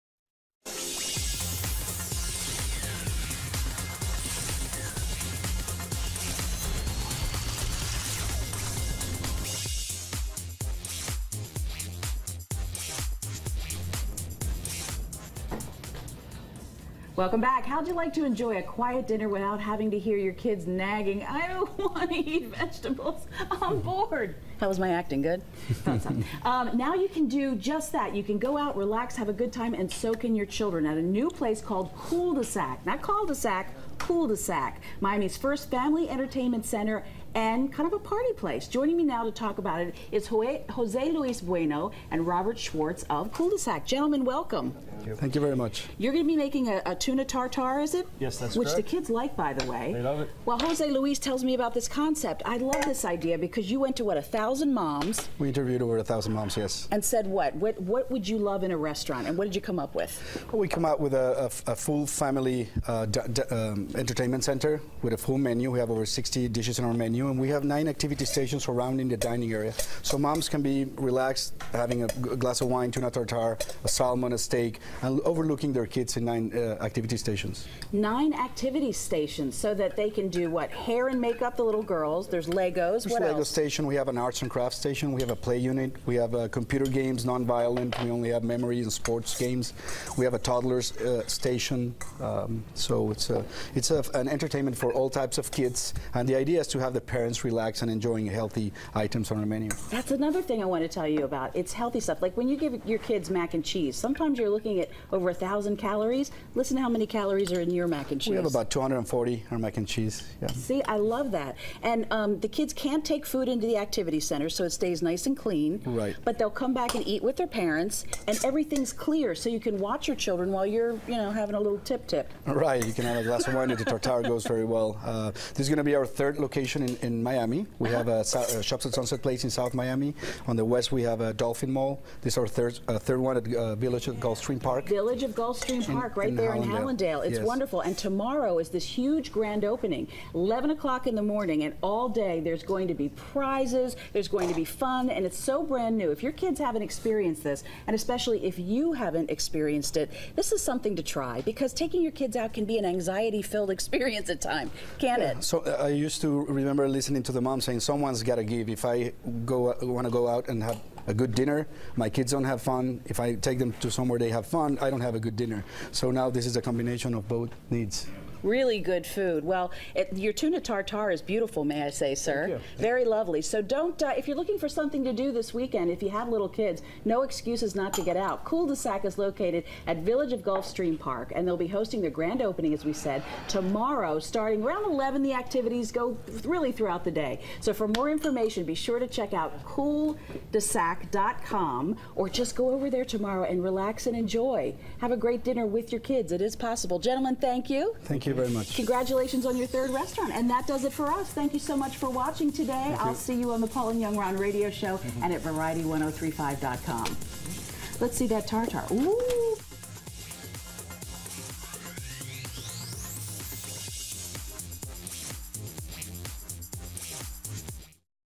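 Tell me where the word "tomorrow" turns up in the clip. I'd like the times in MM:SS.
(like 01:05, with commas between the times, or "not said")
02:17, 03:03, 03:13.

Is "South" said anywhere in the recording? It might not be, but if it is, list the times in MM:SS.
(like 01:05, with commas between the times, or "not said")
02:09.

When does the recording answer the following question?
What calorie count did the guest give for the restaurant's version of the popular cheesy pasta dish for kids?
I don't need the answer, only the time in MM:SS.
01:48.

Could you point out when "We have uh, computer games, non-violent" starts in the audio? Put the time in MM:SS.
01:26.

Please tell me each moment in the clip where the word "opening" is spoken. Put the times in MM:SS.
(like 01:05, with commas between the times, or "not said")
02:19, 03:02.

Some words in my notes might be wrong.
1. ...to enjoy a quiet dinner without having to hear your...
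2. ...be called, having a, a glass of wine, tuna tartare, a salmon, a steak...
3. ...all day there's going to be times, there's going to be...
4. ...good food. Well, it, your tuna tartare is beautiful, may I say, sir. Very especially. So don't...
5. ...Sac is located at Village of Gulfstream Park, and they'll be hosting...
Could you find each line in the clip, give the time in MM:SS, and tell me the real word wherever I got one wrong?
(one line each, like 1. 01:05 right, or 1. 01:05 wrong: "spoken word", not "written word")
1. 00:18 right
2. 01:10 wrong: "relaxed", not "called"
3. 02:21 wrong: "prizes", not "times"
4. 02:48 wrong: "lovely", not "especially"
5. 02:58 right.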